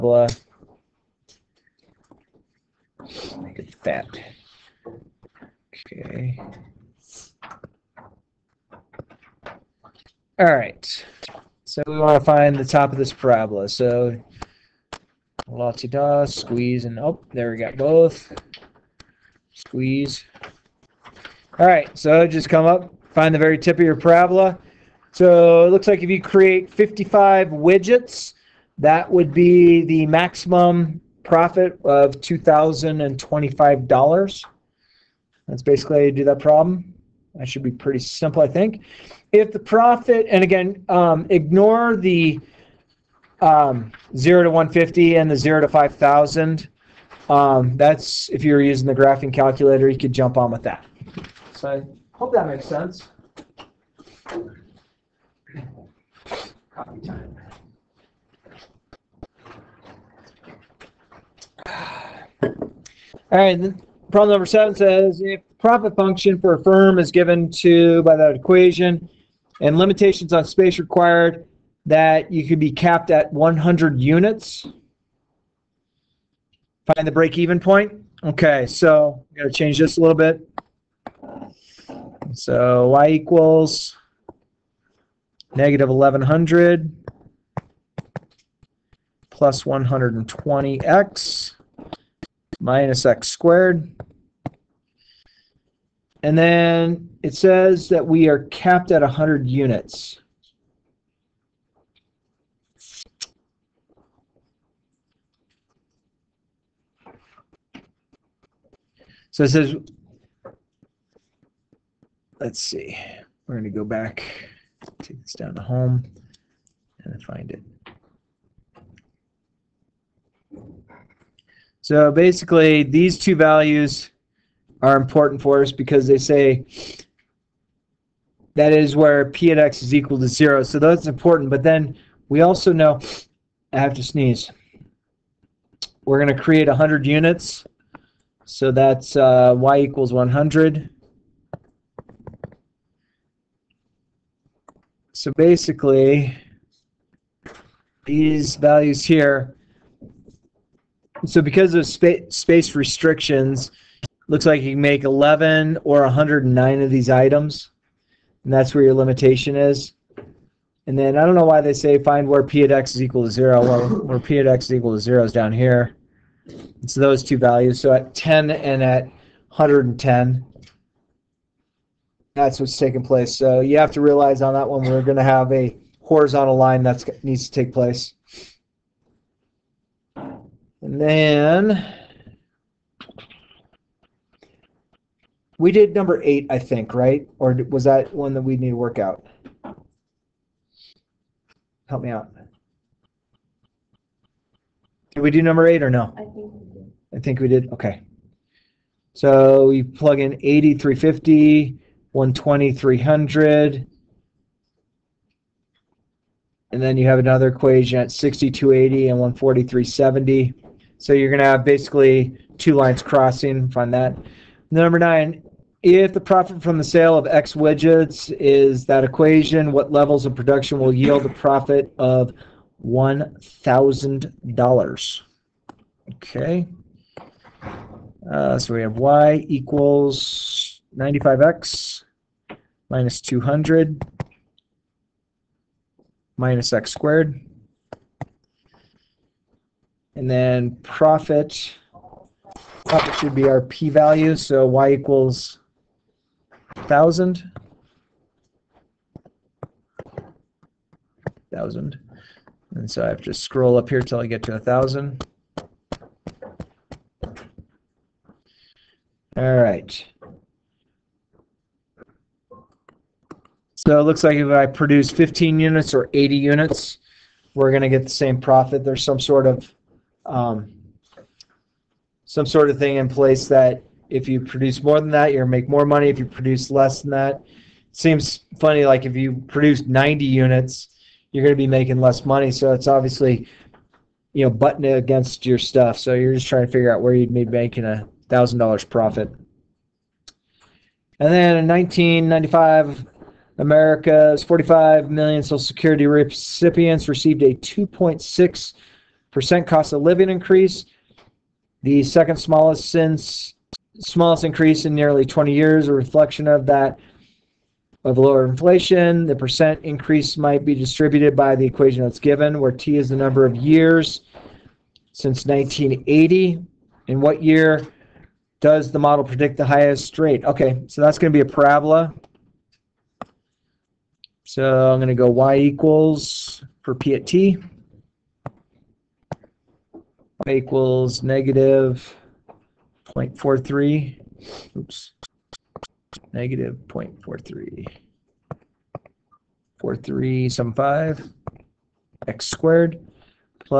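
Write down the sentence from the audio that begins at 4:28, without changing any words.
There's some sort of um, some sort of thing in place that if you produce more than that, you're make more money.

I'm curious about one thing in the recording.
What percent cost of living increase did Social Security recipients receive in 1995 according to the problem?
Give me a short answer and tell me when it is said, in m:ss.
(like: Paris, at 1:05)
2.6%, at 4:57.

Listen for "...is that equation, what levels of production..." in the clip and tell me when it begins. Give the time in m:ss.
3:38.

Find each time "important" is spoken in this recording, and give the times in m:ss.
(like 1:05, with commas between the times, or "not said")
2:04, 2:11.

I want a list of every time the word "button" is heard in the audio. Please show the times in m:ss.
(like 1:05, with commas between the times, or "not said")
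4:44.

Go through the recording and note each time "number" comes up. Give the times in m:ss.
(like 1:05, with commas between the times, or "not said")
1:04, 3:05, 3:15, 3:34, 5:13.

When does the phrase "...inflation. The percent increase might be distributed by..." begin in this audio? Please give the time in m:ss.
5:08.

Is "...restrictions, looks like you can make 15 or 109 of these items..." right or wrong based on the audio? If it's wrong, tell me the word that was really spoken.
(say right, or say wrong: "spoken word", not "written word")
wrong: "11", not "15".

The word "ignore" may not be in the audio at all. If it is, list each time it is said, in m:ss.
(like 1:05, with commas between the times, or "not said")
0:41.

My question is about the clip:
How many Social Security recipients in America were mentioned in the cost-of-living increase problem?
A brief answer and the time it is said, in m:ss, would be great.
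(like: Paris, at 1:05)
45 million, at 4:54.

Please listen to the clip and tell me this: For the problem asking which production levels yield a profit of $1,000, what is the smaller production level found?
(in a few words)
15.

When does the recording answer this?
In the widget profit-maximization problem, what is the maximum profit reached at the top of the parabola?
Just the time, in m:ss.
0:32.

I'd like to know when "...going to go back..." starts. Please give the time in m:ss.
1:53.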